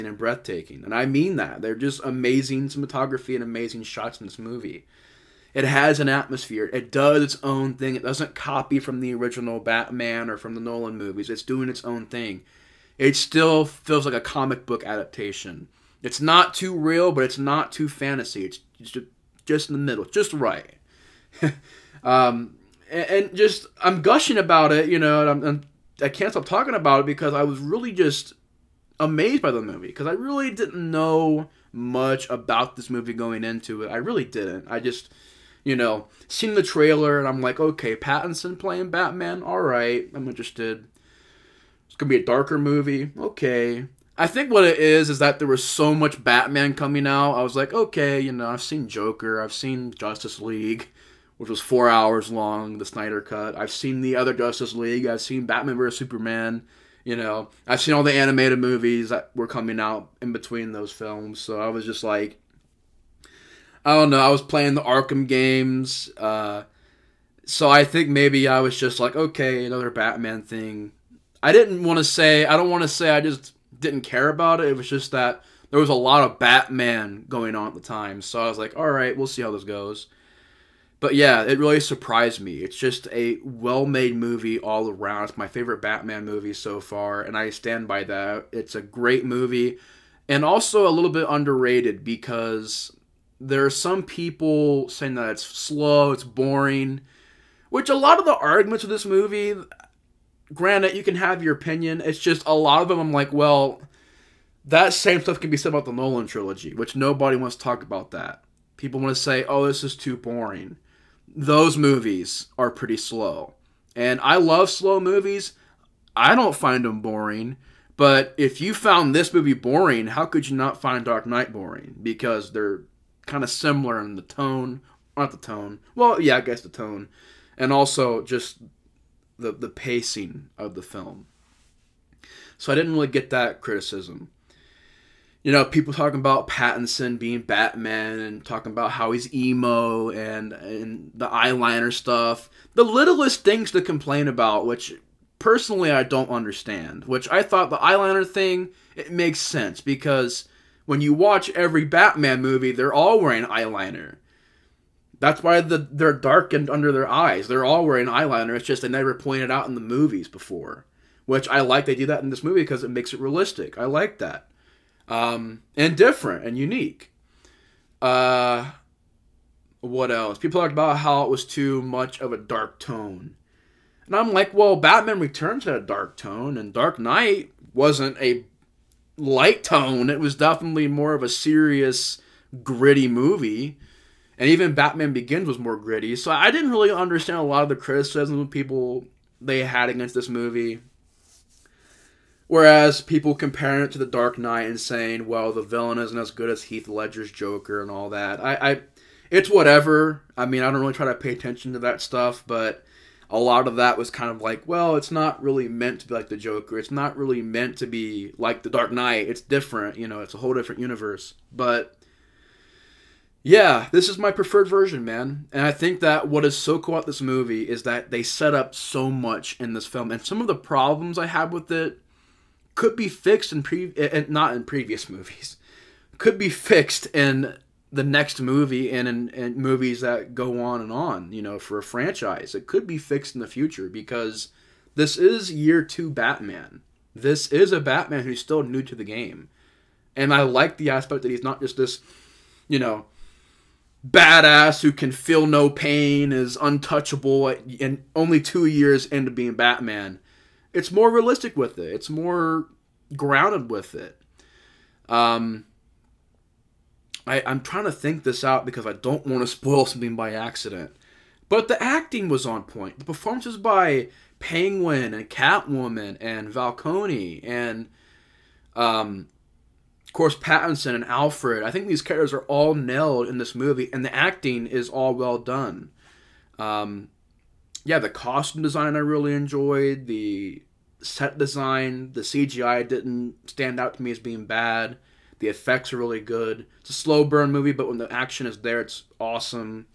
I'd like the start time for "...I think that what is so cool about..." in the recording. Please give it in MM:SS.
03:35.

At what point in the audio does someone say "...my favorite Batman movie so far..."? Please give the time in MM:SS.
01:25.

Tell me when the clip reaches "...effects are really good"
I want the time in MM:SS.
04:45.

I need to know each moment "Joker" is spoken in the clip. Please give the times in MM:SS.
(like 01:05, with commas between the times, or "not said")
00:48, 03:17, 03:26.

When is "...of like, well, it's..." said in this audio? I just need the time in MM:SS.
03:24.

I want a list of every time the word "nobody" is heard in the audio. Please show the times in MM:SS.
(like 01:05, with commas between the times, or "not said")
01:46.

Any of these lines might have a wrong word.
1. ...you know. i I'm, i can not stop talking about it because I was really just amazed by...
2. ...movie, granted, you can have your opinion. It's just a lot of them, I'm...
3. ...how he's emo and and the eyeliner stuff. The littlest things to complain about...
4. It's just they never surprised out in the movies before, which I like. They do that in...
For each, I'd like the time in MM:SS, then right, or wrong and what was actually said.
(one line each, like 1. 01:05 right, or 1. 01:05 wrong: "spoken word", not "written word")
1. 00:24 right
2. 01:39 right
3. 02:18 right
4. 02:38 wrong: "pointed", not "surprised".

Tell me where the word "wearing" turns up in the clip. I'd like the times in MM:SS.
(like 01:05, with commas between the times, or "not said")
02:33, 02:37.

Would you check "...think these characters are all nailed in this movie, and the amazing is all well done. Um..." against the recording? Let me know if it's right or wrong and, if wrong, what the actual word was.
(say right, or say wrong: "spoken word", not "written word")
wrong: "acting", not "amazing".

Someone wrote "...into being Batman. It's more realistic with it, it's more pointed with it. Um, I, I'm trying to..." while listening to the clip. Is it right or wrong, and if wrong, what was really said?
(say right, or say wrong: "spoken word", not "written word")
wrong: "grounded", not "pointed".